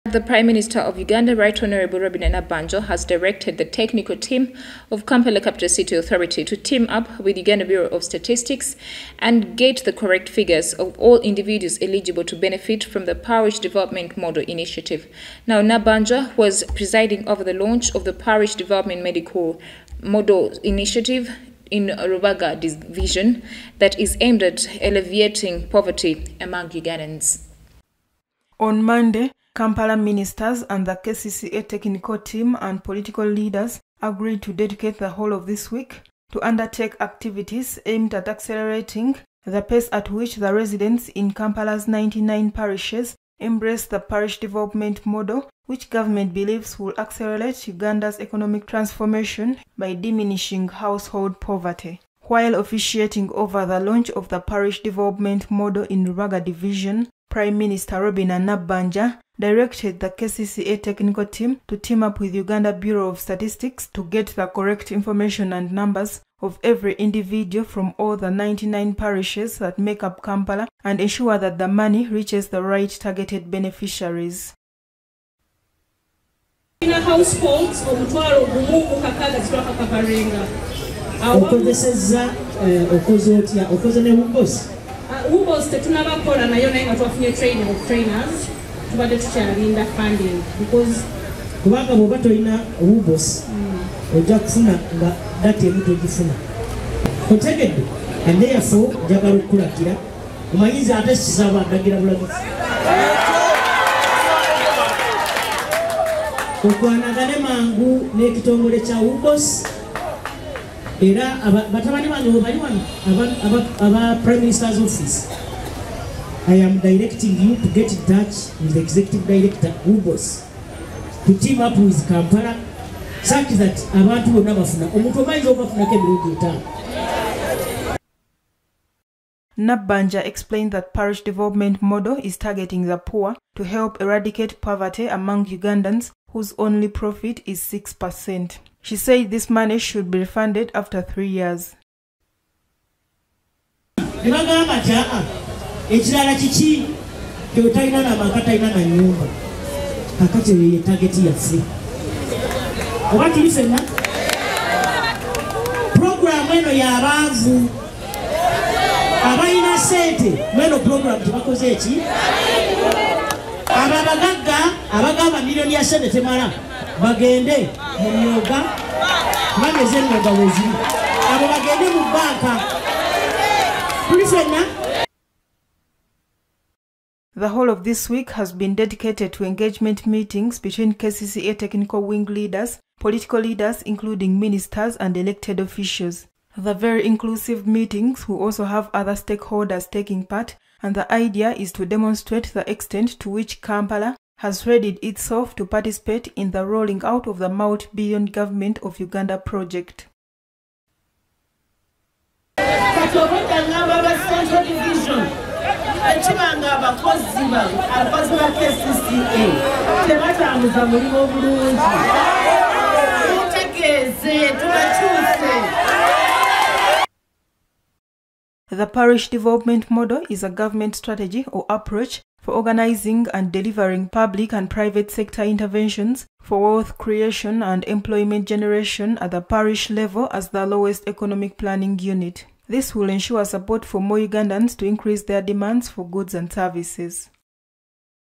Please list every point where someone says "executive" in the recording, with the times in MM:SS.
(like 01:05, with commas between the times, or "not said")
01:58.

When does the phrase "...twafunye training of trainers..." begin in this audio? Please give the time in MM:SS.
01:26.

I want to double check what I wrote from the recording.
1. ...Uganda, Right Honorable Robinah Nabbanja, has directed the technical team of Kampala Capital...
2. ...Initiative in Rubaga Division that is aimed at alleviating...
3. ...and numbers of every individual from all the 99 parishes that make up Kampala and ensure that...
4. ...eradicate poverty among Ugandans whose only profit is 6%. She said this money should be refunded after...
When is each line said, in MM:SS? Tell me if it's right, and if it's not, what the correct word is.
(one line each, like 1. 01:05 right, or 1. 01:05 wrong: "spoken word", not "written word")
1. 00:00 right
2. 00:20 right
3. 01:05 right
4. 02:14 right.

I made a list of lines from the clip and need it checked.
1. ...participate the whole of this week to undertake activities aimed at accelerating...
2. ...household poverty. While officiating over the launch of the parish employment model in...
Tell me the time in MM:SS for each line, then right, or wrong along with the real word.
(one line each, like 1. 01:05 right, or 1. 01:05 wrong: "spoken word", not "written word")
1. 00:34 wrong: "dedicate", not "participate"
2. 00:50 wrong: "development", not "employment".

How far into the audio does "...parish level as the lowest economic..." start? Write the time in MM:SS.
03:49.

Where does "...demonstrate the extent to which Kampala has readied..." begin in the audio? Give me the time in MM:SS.
03:11.